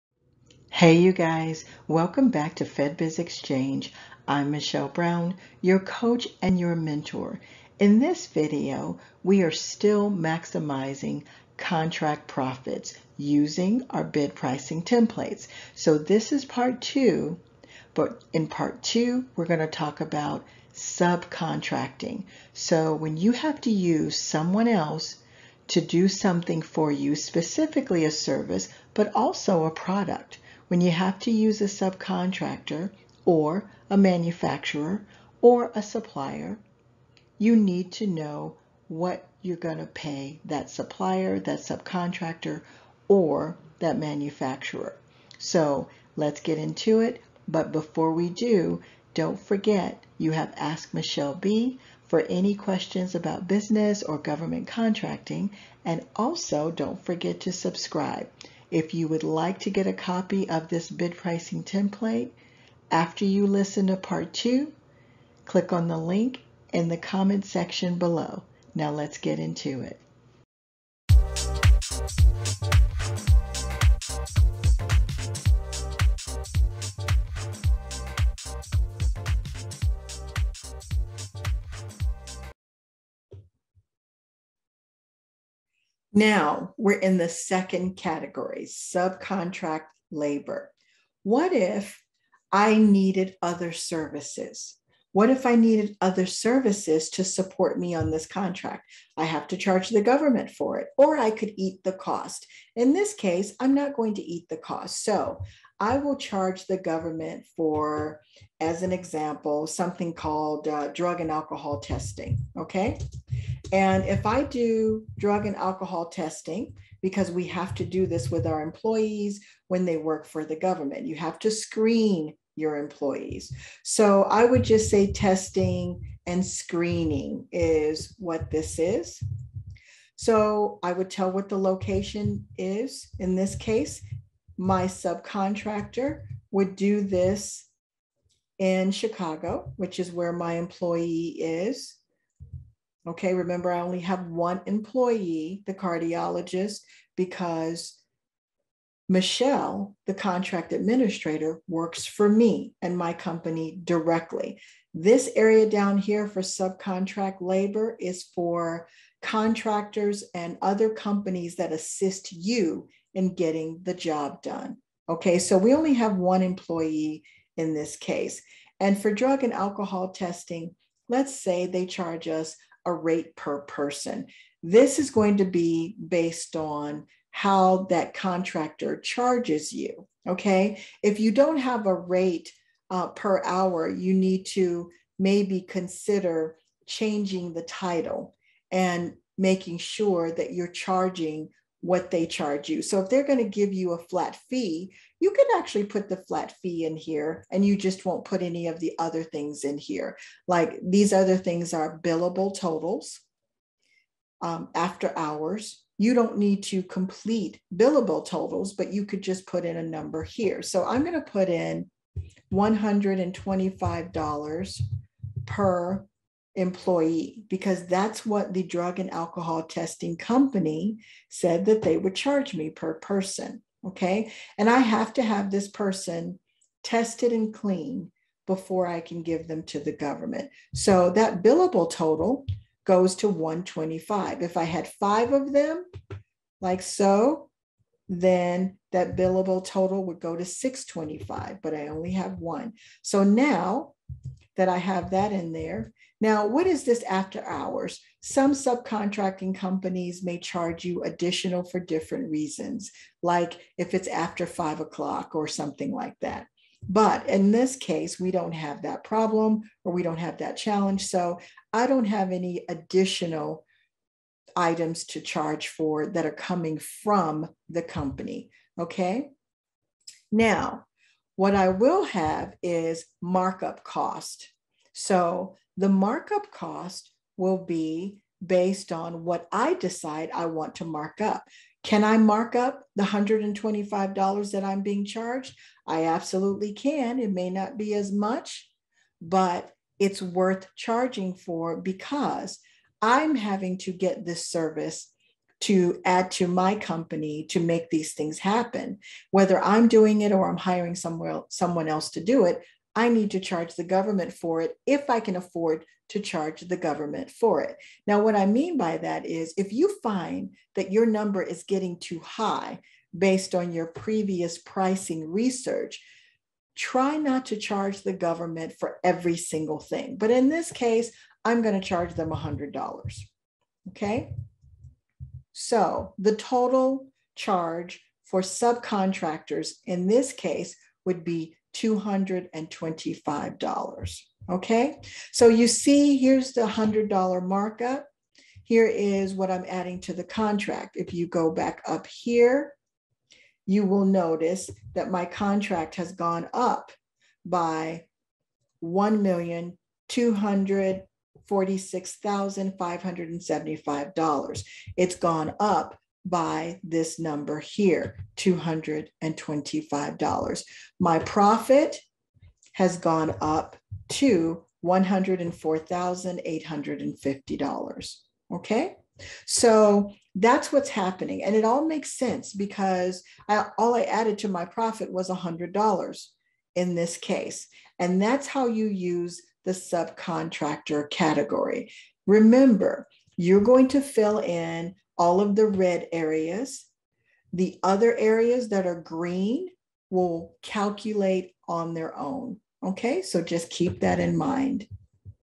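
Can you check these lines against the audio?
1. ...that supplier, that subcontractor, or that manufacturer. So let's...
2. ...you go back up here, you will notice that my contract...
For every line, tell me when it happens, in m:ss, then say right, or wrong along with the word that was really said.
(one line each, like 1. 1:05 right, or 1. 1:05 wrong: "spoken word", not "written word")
1. 0:40 right
2. 5:41 right.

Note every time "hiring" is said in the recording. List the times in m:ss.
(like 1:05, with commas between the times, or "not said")
5:00.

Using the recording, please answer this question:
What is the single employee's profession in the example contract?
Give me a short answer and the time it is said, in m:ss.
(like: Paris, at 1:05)
cardiologist, at 2:25.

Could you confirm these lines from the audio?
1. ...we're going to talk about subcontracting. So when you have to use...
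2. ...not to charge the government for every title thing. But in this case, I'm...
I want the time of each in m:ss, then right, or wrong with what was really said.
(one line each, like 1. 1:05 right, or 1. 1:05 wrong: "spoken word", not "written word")
1. 0:19 right
2. 5:17 wrong: "single", not "title".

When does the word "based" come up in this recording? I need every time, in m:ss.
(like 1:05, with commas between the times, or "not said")
2:56, 4:38, 5:13.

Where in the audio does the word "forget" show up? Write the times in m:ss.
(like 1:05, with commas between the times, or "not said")
0:49, 0:57.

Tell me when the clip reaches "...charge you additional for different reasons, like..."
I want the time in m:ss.
4:10.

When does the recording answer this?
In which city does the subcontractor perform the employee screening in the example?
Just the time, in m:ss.
2:18.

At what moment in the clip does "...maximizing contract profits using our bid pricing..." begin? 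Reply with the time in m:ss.
0:10.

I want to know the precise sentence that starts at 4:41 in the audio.
Can I mark up the $125 that I'm being charged?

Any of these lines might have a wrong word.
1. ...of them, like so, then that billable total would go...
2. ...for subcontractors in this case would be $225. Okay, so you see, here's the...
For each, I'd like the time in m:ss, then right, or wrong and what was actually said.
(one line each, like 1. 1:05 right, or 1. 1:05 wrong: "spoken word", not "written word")
1. 3:55 right
2. 5:28 right.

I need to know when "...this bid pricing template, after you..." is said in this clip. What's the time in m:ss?
1:00.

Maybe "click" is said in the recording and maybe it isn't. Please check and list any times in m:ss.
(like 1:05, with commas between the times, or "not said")
1:05.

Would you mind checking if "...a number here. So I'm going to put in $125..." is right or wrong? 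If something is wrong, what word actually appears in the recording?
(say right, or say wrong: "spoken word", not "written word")
right.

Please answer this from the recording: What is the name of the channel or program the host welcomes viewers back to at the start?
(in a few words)
FedBiz Exchange.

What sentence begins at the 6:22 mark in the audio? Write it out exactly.
Remember, you're going to fill in all of the red areas.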